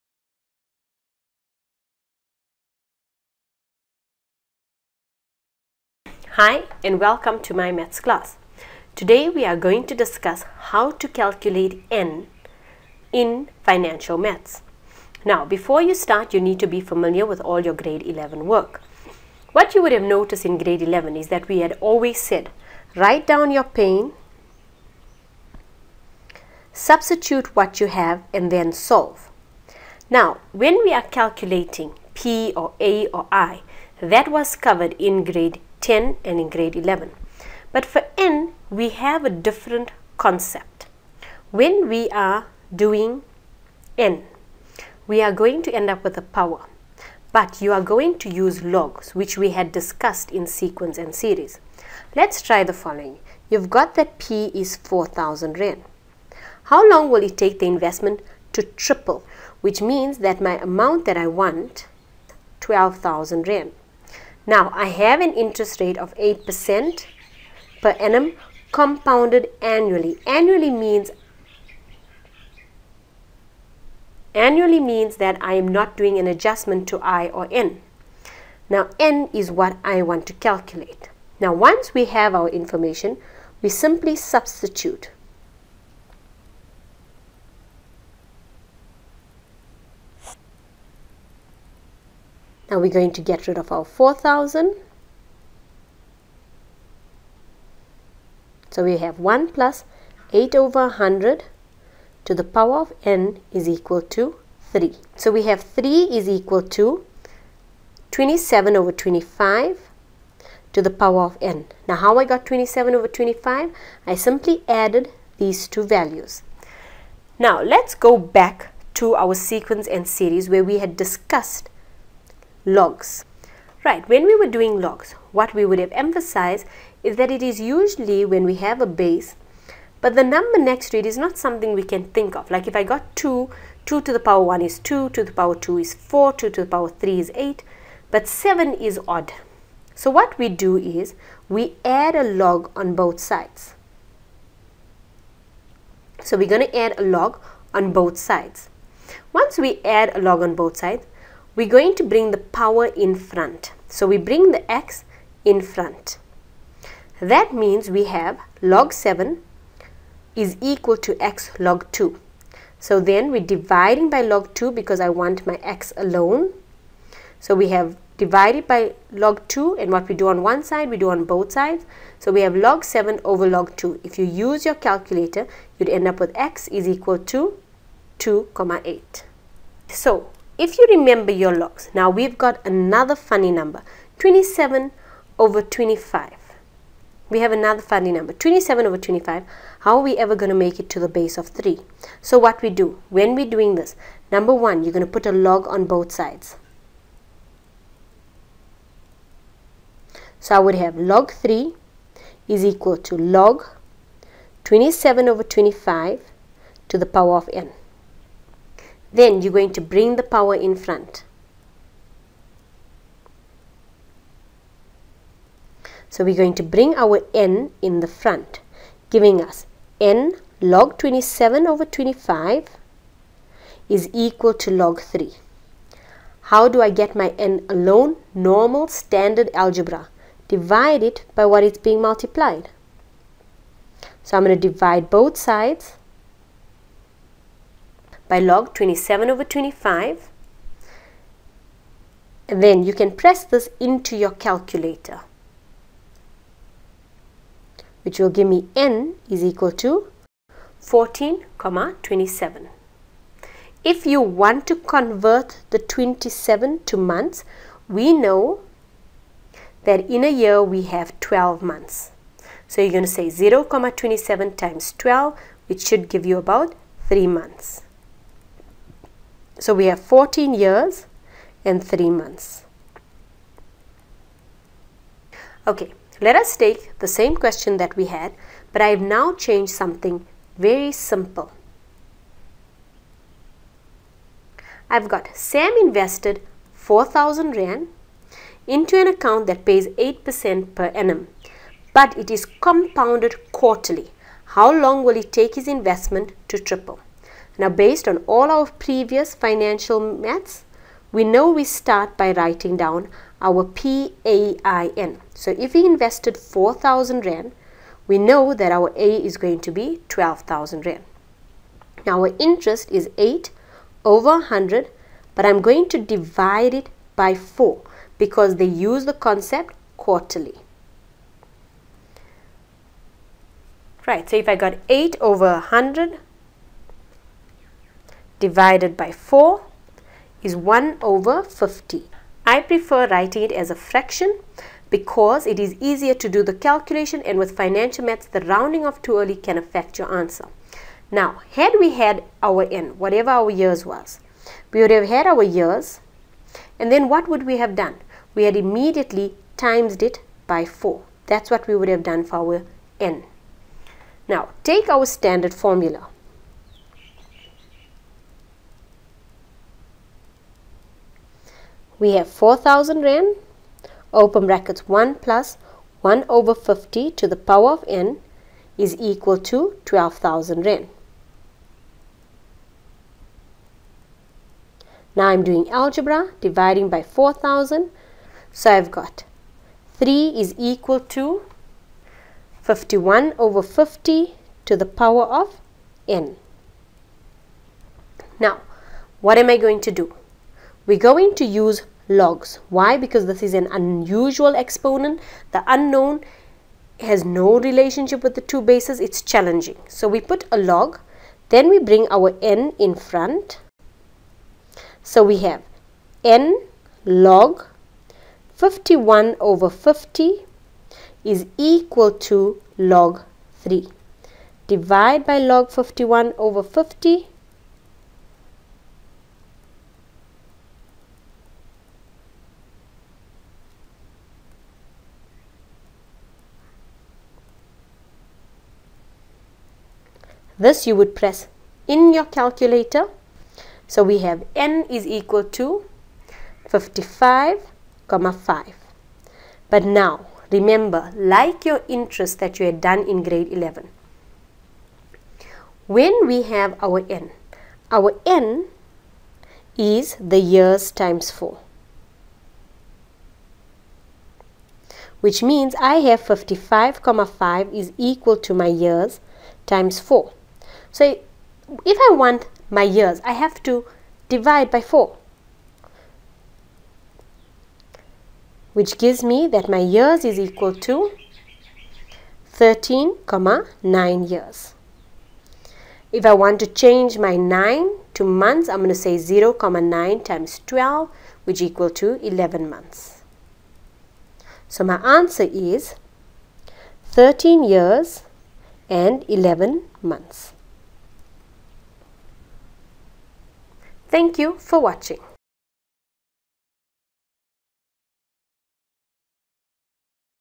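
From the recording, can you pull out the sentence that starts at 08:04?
So my answer is 13 years and 11 months.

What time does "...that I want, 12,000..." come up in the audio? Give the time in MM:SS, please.
01:01.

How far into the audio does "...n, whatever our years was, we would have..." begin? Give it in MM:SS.
05:42.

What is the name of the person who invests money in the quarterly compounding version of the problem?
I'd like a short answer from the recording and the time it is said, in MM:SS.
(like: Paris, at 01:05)
Sam, at 04:45.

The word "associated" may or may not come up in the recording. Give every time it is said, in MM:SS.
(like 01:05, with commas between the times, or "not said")
not said.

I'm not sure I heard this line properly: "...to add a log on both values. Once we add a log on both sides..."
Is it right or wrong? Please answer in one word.
wrong.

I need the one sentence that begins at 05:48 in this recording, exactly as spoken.
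We had immediately times it by 4.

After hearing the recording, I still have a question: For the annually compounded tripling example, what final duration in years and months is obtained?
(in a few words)
14 years and 3 months.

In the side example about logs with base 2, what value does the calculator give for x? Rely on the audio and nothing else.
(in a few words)
2.8.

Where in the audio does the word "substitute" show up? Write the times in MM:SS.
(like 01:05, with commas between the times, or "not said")
00:26, 01:24.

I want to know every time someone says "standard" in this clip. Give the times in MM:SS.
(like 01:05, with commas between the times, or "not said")
03:48, 05:55.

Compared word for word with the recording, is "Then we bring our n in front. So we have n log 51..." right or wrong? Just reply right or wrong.
right.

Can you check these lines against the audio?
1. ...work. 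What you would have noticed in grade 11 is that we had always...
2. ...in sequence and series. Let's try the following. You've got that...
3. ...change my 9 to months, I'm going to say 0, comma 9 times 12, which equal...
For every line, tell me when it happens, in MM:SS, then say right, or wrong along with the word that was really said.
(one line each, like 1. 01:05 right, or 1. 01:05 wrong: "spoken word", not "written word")
1. 00:18 right
2. 00:50 right
3. 07:56 right.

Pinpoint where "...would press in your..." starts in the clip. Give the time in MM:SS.
07:10.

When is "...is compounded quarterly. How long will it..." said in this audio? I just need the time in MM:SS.
04:52.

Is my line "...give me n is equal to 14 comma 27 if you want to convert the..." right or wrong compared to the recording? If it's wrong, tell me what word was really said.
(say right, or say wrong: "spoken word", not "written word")
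right.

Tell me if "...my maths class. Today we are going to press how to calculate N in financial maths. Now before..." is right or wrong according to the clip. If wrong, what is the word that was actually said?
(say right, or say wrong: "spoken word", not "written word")
wrong: "discuss", not "press".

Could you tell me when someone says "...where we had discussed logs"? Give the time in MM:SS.
02:00.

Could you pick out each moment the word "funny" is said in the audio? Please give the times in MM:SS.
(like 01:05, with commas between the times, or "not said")
03:03, 03:07.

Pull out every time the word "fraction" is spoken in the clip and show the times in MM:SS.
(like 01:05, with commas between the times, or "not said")
05:33.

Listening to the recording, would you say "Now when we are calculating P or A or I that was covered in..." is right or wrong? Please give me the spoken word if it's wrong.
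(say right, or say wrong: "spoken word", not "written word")
right.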